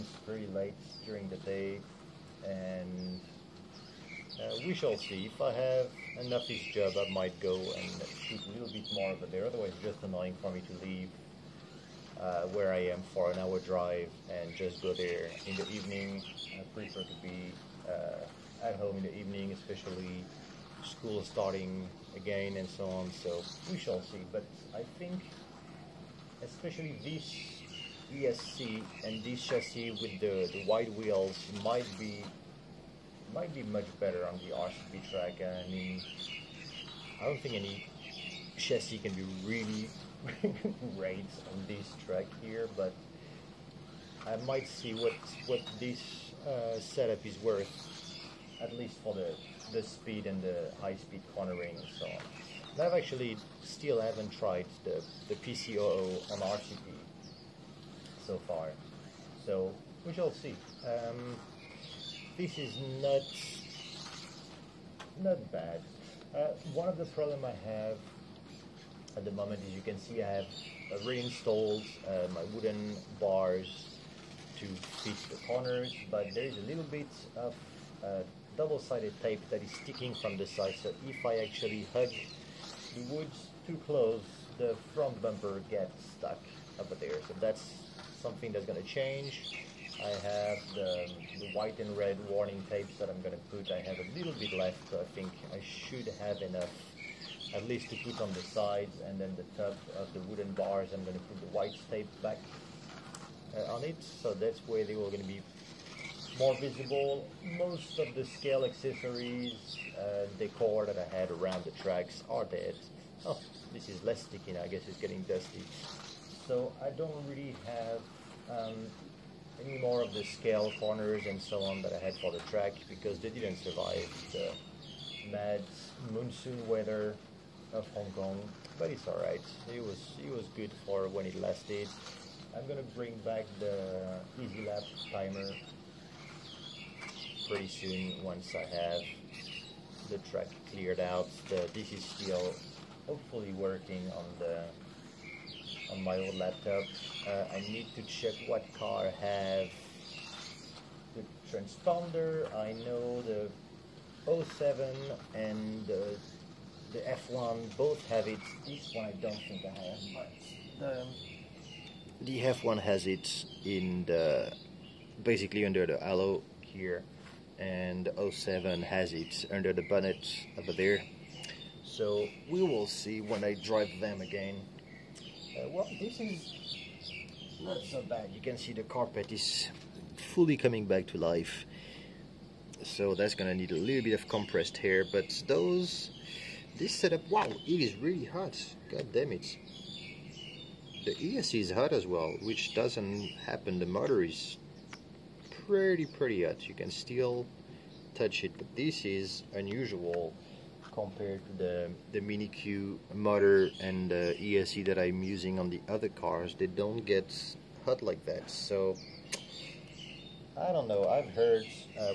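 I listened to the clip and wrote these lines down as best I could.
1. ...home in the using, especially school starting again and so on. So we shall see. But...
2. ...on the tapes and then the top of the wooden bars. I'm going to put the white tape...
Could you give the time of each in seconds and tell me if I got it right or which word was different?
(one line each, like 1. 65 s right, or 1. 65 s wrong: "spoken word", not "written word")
1. 18 s wrong: "evening", not "using"
2. 98 s wrong: "sides", not "tapes".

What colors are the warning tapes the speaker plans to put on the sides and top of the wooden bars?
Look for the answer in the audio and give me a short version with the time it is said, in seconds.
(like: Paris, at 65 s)
white and red, at 91 s.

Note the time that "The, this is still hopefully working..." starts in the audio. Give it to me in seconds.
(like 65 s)
141 s.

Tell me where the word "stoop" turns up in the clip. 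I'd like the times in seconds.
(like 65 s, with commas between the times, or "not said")
not said.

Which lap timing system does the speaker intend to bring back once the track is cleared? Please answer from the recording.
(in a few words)
Easy Lap.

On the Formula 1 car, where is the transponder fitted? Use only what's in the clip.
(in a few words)
under the halo.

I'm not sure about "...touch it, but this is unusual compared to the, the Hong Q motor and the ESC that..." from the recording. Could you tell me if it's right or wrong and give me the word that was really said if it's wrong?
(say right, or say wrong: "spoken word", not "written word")
wrong: "Mini", not "Hong".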